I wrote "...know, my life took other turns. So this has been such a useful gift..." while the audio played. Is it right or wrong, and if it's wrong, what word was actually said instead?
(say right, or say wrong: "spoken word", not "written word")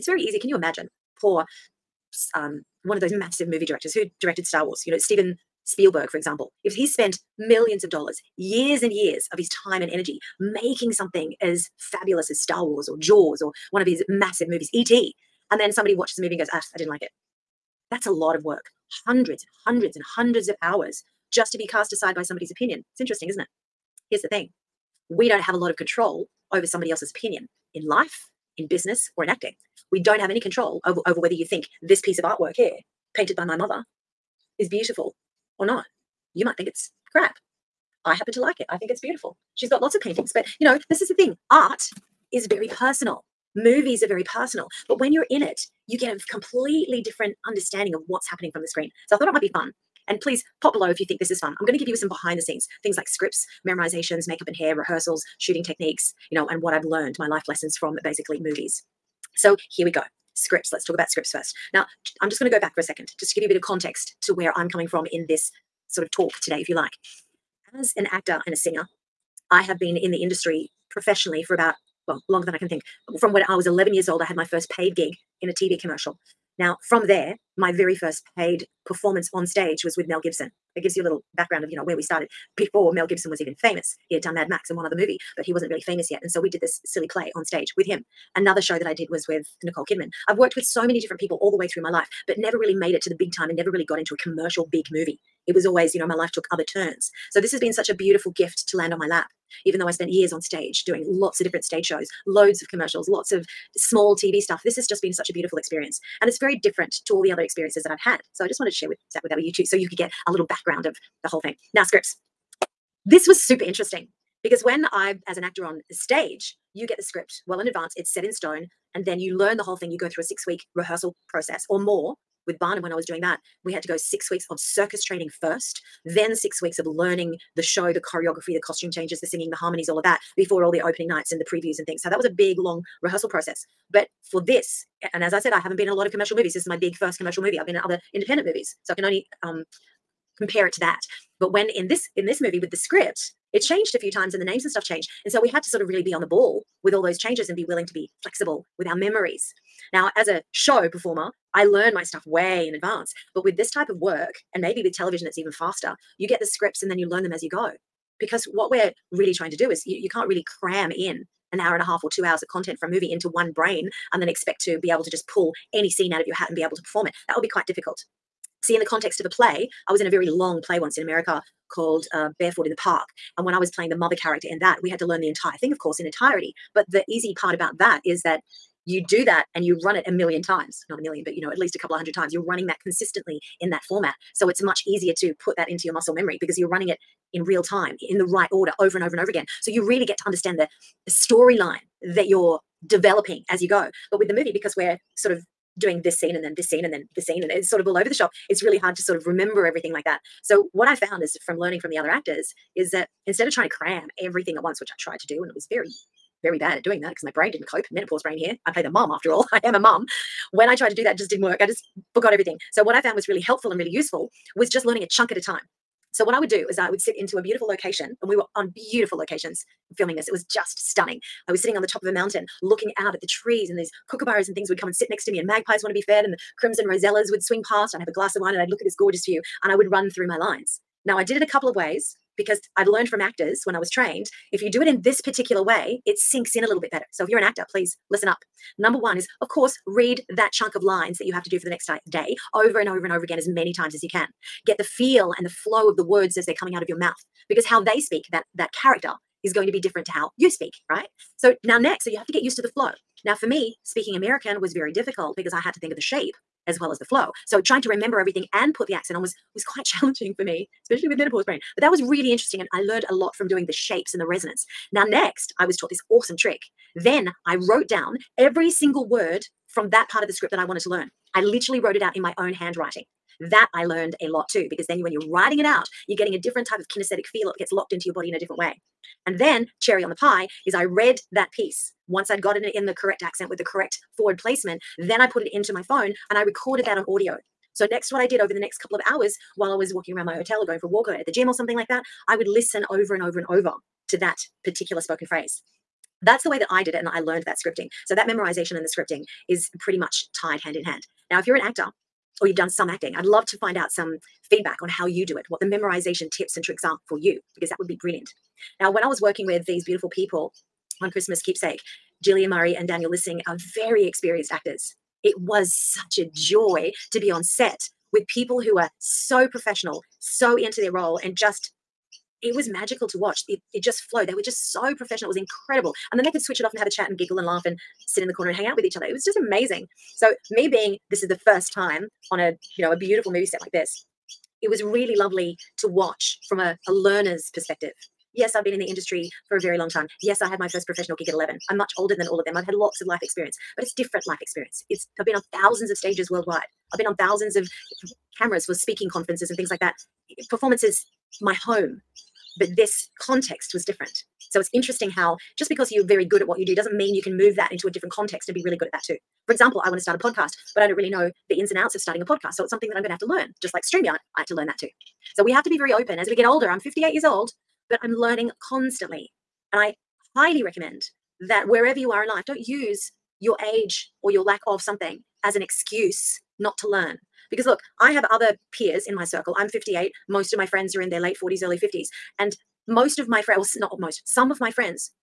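wrong: "beautiful", not "useful".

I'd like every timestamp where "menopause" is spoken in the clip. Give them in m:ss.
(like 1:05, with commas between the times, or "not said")
3:27, 4:21.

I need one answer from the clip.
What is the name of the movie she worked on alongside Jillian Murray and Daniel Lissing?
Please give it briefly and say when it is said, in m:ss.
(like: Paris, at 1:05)
Christmas Keepsake, at 5:11.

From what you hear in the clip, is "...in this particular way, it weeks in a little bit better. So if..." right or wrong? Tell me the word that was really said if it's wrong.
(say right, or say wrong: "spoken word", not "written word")
wrong: "sinks", not "weeks".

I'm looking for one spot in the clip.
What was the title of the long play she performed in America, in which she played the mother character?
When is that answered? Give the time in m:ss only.
2:52.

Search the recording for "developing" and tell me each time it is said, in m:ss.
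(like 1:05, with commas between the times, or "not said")
3:12.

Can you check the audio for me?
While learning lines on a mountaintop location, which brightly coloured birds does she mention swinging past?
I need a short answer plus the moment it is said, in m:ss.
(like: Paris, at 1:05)
crimson rosellas, at 3:46.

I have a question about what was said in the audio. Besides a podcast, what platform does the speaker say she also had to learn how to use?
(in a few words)
StreamYard.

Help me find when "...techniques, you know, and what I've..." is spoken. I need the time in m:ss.
0:55.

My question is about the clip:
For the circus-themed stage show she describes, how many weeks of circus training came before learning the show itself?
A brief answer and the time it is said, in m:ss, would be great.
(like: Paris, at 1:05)
6, at 2:03.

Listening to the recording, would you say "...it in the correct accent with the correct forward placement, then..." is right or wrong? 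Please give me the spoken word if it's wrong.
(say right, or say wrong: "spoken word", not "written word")
right.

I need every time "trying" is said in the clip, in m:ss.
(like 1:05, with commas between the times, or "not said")
2:39, 3:23, 4:17.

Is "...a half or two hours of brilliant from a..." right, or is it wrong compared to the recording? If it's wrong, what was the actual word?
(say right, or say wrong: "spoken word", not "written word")
wrong: "content", not "brilliant".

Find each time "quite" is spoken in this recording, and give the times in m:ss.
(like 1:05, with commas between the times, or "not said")
2:47, 4:19.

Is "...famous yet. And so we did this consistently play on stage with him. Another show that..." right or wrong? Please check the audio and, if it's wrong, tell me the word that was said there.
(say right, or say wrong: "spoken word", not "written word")
wrong: "silly", not "consistently".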